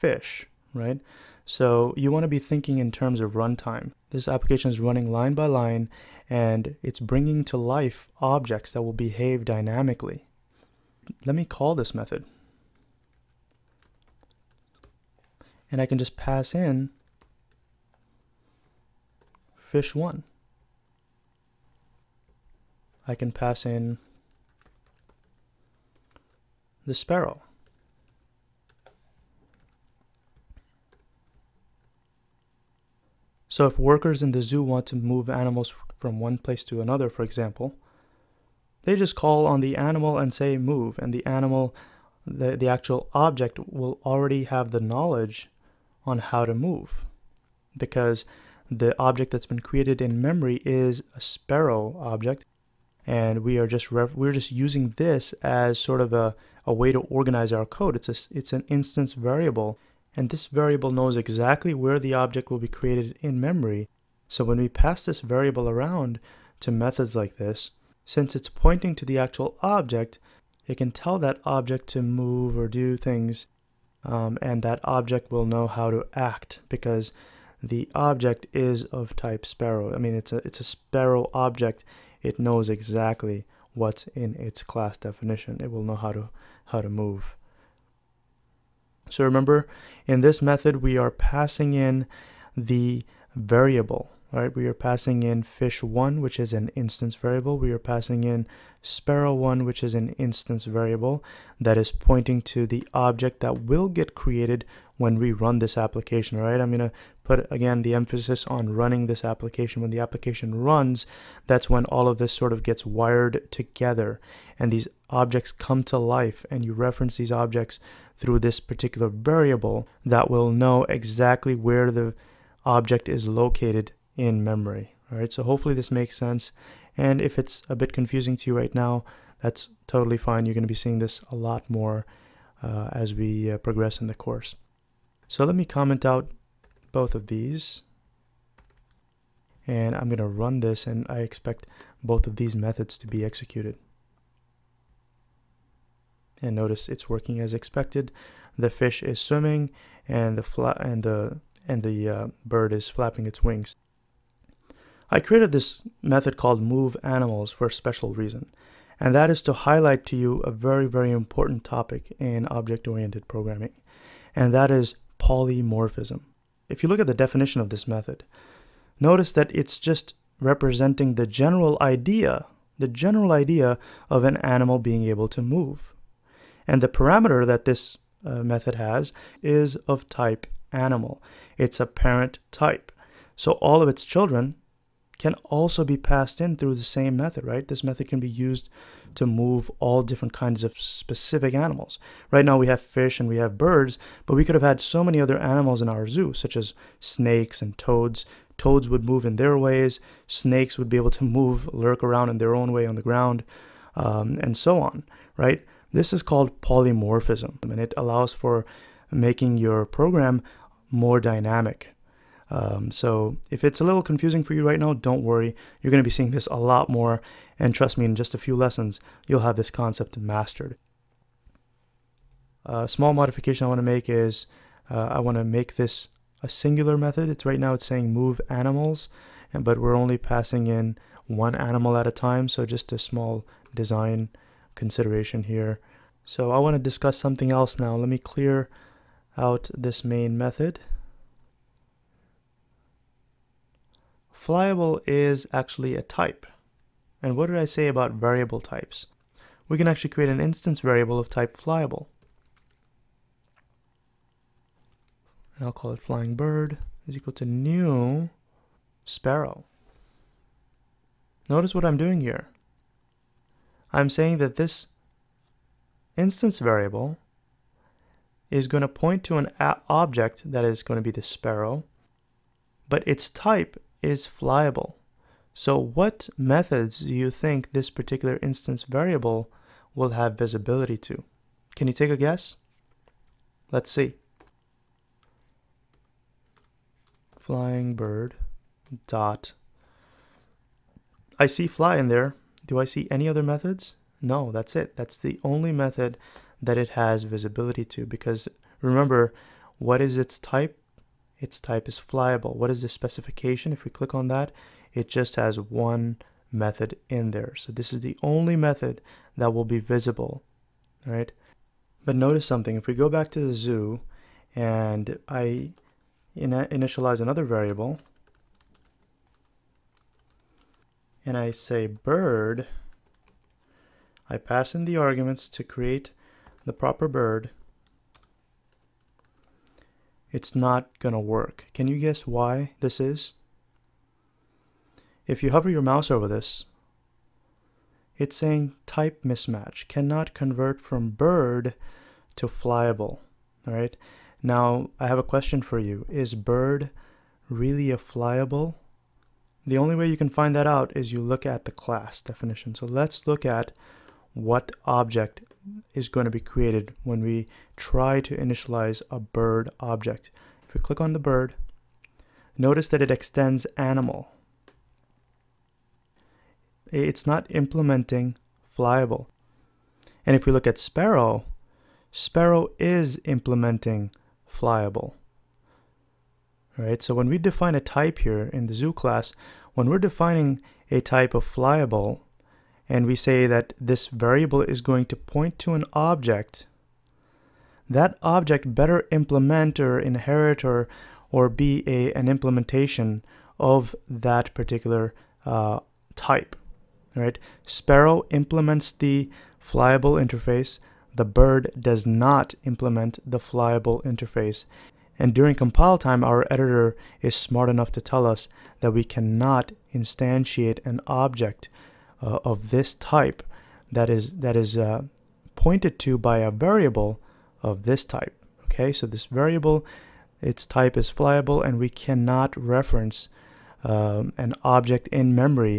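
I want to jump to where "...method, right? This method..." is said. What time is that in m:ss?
3:07.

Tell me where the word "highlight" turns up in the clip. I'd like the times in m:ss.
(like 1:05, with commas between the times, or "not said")
2:39.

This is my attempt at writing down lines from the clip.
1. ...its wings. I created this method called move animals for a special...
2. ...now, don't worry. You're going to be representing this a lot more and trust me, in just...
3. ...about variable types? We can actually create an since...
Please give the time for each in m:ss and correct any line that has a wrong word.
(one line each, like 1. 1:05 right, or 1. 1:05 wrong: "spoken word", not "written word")
1. 2:33 right
2. 3:34 wrong: "seeing", not "representing"
3. 4:07 wrong: "instance", not "since".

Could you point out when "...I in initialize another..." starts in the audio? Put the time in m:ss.
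5:15.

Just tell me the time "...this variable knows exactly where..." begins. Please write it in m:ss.
1:00.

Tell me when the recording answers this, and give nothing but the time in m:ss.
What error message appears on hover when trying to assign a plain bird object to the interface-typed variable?
5:38.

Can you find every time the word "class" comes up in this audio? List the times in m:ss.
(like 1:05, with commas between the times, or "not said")
1:24, 5:51, 6:18.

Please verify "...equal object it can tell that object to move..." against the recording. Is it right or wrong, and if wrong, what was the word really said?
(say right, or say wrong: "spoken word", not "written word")
wrong: "actual", not "equal".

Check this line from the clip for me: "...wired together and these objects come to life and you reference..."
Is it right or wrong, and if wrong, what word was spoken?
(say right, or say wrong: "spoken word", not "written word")
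right.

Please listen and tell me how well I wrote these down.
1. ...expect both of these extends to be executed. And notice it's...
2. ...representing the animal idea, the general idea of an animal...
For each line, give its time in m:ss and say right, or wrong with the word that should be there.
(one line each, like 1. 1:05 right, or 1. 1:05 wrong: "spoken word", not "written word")
1. 2:21 wrong: "methods", not "extends"
2. 2:50 wrong: "general", not "animal".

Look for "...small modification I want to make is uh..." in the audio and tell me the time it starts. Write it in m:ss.
3:42.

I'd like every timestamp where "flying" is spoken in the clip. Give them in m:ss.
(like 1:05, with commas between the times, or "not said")
4:16, 4:47.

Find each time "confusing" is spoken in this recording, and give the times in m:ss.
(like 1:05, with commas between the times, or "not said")
2:07, 3:34.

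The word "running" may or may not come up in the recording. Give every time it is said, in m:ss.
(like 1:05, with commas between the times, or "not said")
0:04, 1:48.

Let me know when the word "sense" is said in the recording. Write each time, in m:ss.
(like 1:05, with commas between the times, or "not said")
2:06.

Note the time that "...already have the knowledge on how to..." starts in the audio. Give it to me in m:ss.
0:44.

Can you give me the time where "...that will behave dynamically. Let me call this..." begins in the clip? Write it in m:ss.
0:08.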